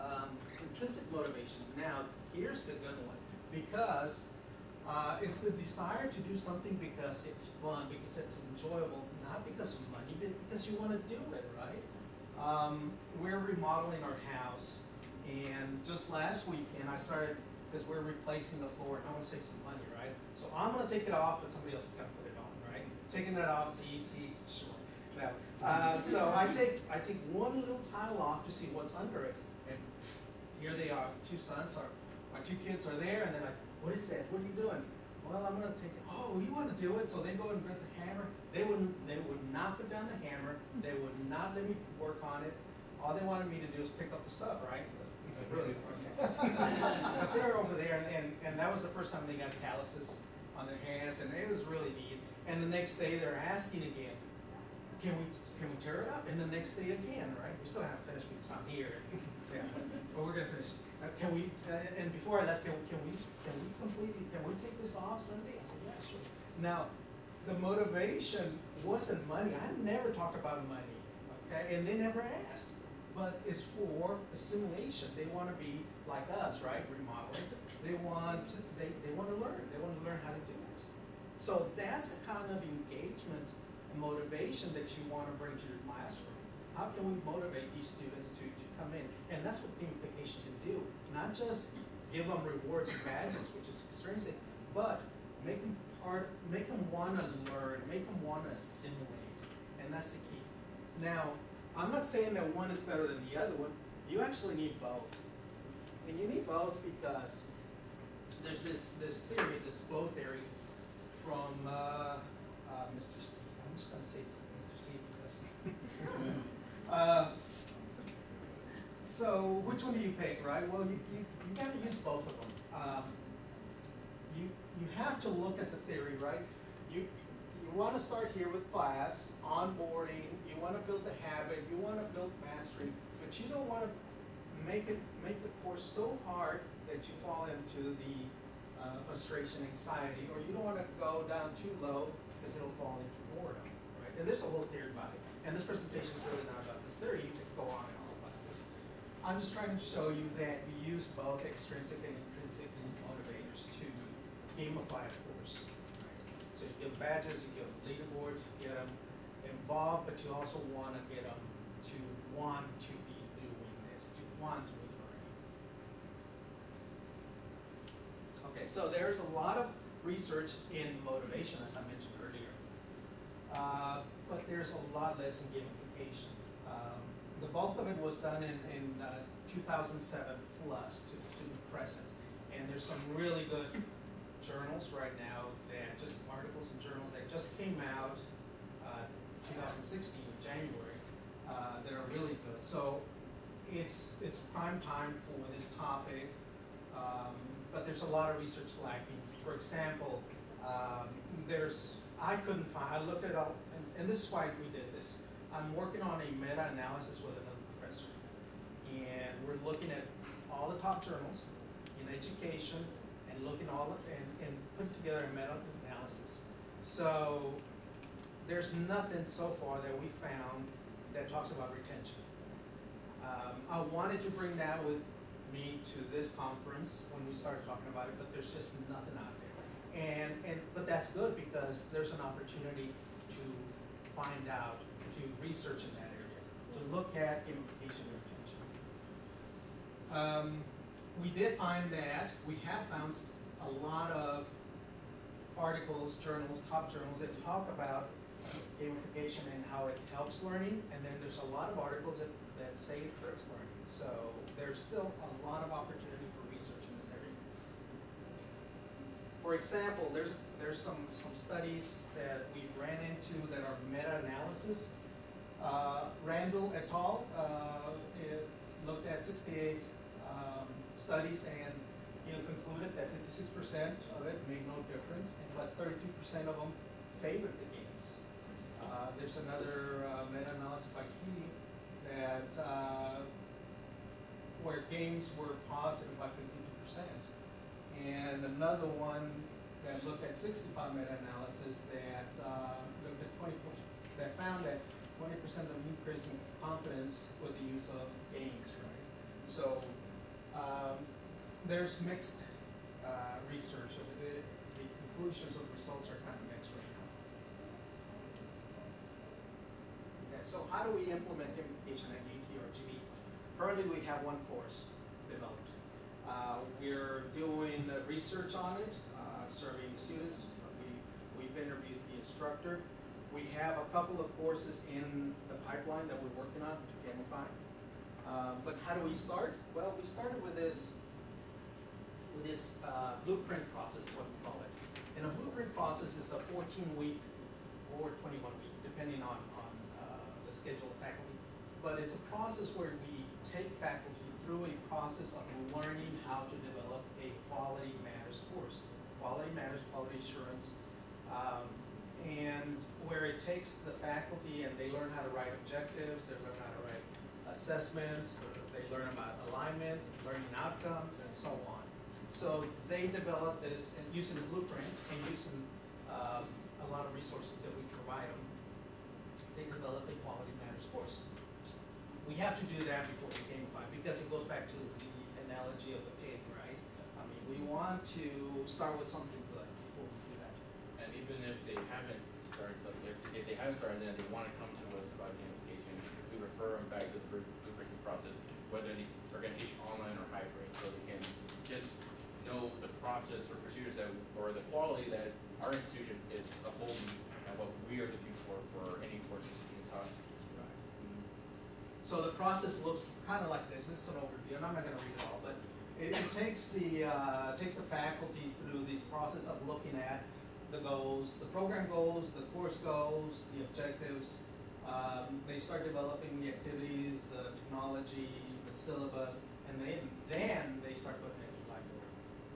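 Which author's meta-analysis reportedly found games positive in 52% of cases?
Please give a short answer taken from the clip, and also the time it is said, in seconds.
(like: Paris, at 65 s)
Ke, at 281 s.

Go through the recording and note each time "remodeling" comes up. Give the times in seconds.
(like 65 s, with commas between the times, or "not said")
13 s, 76 s.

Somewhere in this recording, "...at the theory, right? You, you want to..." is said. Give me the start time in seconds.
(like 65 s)
125 s.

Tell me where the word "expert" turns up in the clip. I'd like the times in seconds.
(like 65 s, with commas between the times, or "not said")
not said.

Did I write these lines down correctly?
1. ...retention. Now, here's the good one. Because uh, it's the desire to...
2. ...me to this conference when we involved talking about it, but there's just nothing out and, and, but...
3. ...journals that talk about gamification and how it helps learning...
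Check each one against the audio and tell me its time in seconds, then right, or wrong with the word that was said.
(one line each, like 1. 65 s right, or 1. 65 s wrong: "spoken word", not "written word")
1. 1 s wrong: "motivation", not "retention"
2. 225 s wrong: "started", not "involved"
3. 246 s right.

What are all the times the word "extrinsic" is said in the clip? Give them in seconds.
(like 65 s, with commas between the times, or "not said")
93 s, 151 s.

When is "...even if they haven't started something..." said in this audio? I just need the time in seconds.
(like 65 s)
381 s.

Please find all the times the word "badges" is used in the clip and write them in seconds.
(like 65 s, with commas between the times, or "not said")
93 s, 157 s.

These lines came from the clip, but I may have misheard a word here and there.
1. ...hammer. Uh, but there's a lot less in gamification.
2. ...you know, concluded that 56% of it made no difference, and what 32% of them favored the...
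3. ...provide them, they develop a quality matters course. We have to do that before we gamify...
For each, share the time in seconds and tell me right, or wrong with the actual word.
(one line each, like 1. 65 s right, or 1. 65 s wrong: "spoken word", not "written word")
1. 172 s wrong: "earlier", not "hammer"
2. 272 s right
3. 367 s right.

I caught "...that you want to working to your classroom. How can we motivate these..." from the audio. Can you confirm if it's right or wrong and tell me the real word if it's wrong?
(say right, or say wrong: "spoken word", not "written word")
wrong: "bring", not "working".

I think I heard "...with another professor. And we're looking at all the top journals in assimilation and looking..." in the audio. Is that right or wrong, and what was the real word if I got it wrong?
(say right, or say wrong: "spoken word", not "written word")
wrong: "education", not "assimilation".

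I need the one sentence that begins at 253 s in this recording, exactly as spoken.
So there's still a lot of opportunity For example, there's there's some some studies that we ran into that are meta-analysis.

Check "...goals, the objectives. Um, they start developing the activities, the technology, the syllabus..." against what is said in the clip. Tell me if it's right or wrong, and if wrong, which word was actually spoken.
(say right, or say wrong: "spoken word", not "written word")
right.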